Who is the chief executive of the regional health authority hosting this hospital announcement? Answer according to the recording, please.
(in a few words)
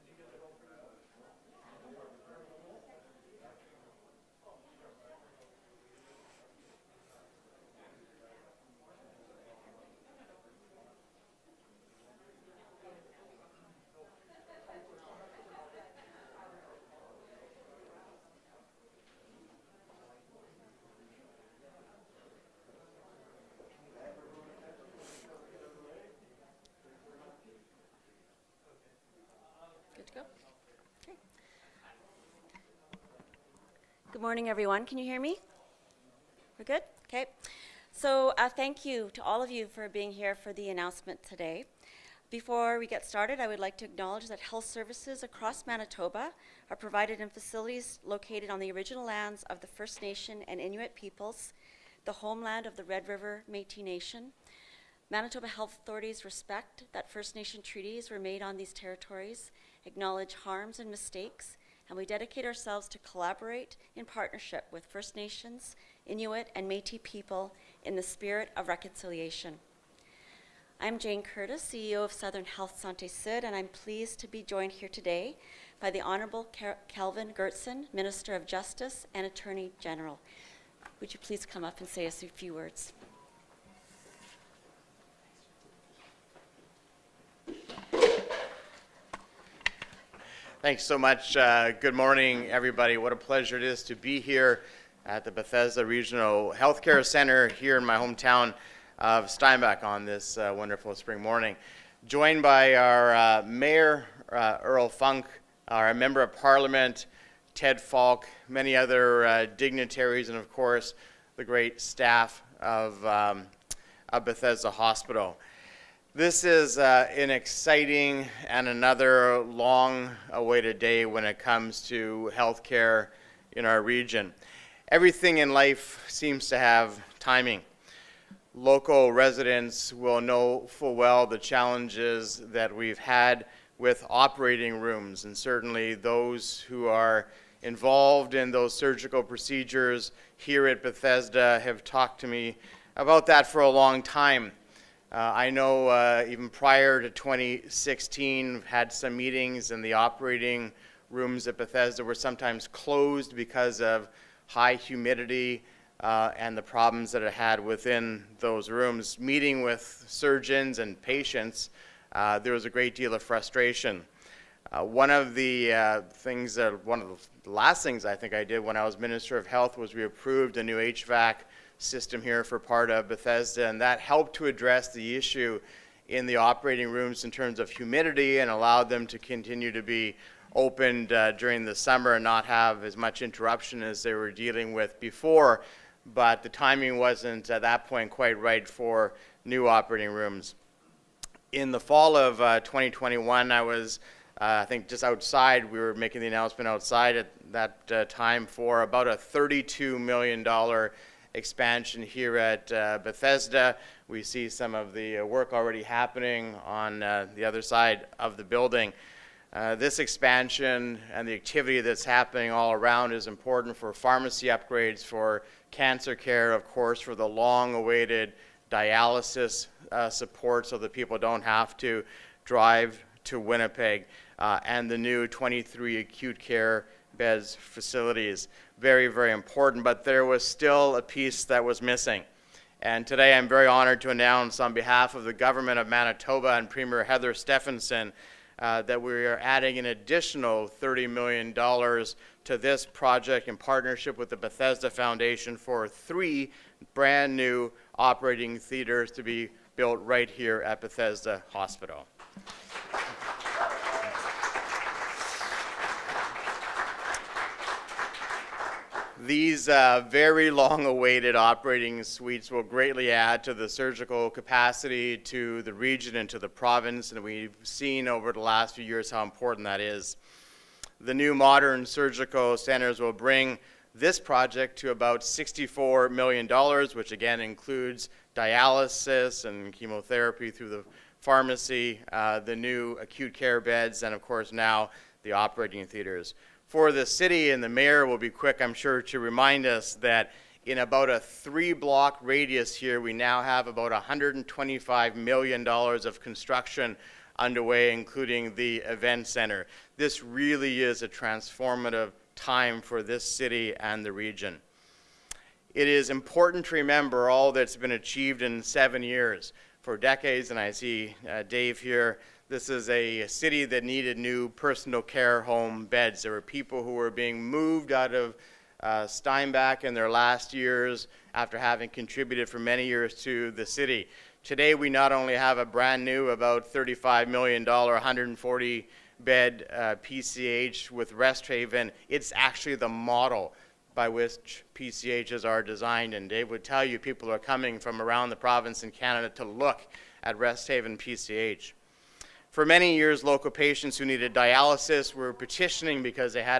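Jane Curtis.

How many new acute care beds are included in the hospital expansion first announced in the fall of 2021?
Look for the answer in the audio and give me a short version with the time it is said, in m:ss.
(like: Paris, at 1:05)
23, at 3:45.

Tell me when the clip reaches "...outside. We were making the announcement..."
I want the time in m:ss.
3:15.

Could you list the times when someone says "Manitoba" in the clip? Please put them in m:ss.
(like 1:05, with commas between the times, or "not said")
0:45, 0:55, 3:55.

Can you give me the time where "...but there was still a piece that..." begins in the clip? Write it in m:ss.
3:49.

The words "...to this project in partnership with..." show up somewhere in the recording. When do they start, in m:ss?
4:01.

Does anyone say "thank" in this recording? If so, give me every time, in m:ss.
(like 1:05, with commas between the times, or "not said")
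0:38, 1:30.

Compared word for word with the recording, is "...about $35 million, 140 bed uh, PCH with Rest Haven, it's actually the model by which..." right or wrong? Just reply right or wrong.
right.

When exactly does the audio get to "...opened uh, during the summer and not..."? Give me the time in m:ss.
3:00.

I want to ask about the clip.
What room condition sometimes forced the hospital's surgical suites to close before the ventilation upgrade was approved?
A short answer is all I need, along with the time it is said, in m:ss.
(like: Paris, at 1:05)
High humidity, at 2:34.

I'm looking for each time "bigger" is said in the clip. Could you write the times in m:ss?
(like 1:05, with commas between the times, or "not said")
not said.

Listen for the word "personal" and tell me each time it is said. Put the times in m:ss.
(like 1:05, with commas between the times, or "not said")
5:14.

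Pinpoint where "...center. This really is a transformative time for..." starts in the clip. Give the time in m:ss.
4:59.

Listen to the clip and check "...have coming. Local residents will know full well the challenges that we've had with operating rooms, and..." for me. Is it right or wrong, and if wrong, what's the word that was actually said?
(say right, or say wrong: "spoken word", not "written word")
wrong: "timing", not "coming".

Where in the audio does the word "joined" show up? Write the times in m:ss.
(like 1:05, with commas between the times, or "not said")
1:14, 1:42.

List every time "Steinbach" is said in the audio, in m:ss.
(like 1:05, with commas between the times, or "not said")
1:39, 5:19.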